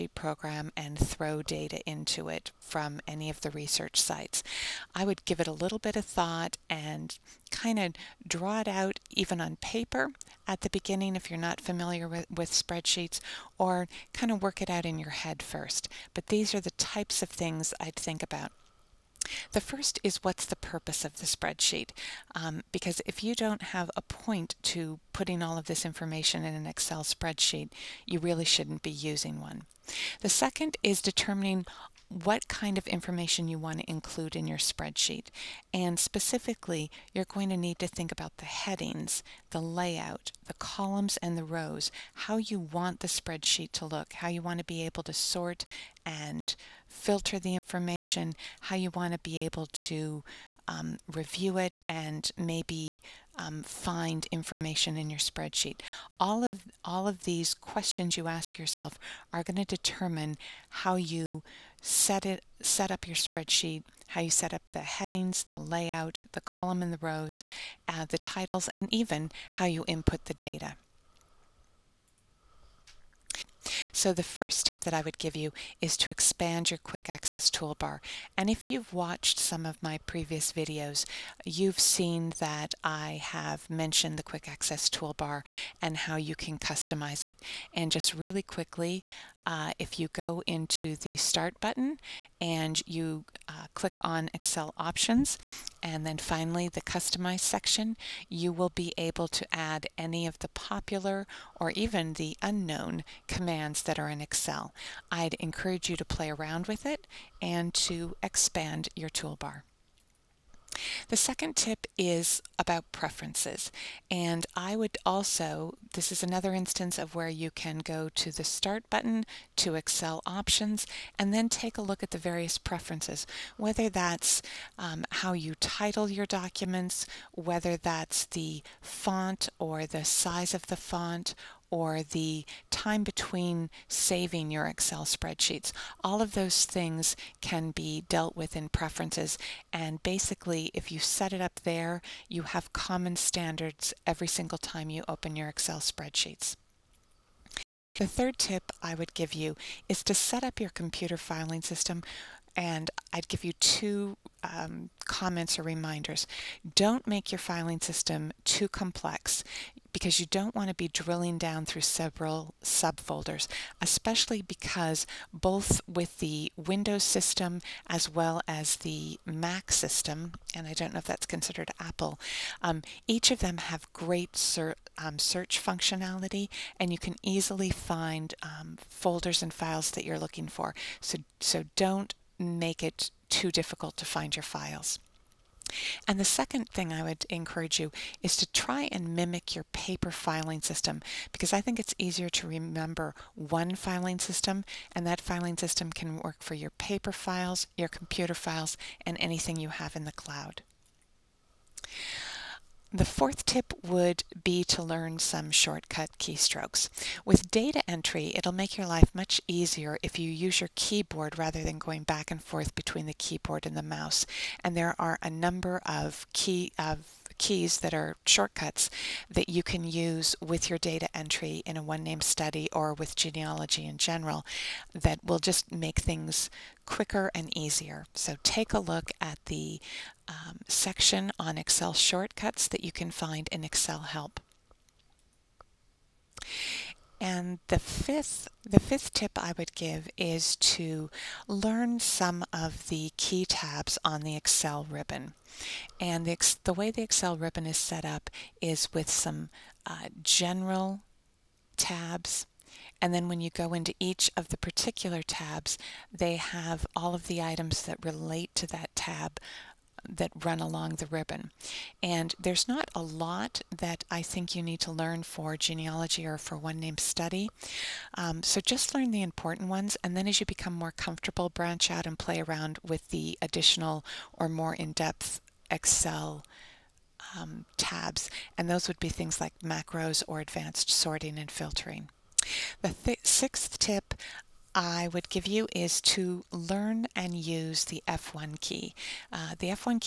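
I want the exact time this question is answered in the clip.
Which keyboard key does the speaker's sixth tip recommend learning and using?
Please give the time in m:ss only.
4:48.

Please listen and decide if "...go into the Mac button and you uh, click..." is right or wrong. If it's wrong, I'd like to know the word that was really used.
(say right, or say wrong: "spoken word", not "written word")
wrong: "Start", not "Mac".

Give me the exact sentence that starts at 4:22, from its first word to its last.
And there's not a lot that I think you need to learn for genealogy or for one name study.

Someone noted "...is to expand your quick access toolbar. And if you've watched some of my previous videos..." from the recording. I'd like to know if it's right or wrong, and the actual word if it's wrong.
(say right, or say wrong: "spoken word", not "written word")
right.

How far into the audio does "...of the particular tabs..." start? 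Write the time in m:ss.
4:14.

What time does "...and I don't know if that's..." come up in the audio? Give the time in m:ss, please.
2:50.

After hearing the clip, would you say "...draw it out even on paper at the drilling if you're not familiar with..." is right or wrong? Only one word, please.
wrong.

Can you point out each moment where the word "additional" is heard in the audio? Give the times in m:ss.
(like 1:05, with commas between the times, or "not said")
4:33.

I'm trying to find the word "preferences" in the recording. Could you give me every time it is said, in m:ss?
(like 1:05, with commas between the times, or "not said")
1:52, 2:02, 2:18.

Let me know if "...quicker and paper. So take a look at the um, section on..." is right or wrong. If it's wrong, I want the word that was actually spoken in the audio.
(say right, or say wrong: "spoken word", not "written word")
wrong: "easier", not "paper".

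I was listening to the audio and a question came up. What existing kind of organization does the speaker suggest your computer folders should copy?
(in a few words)
paper filing system.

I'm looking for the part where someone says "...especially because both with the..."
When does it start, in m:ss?
2:43.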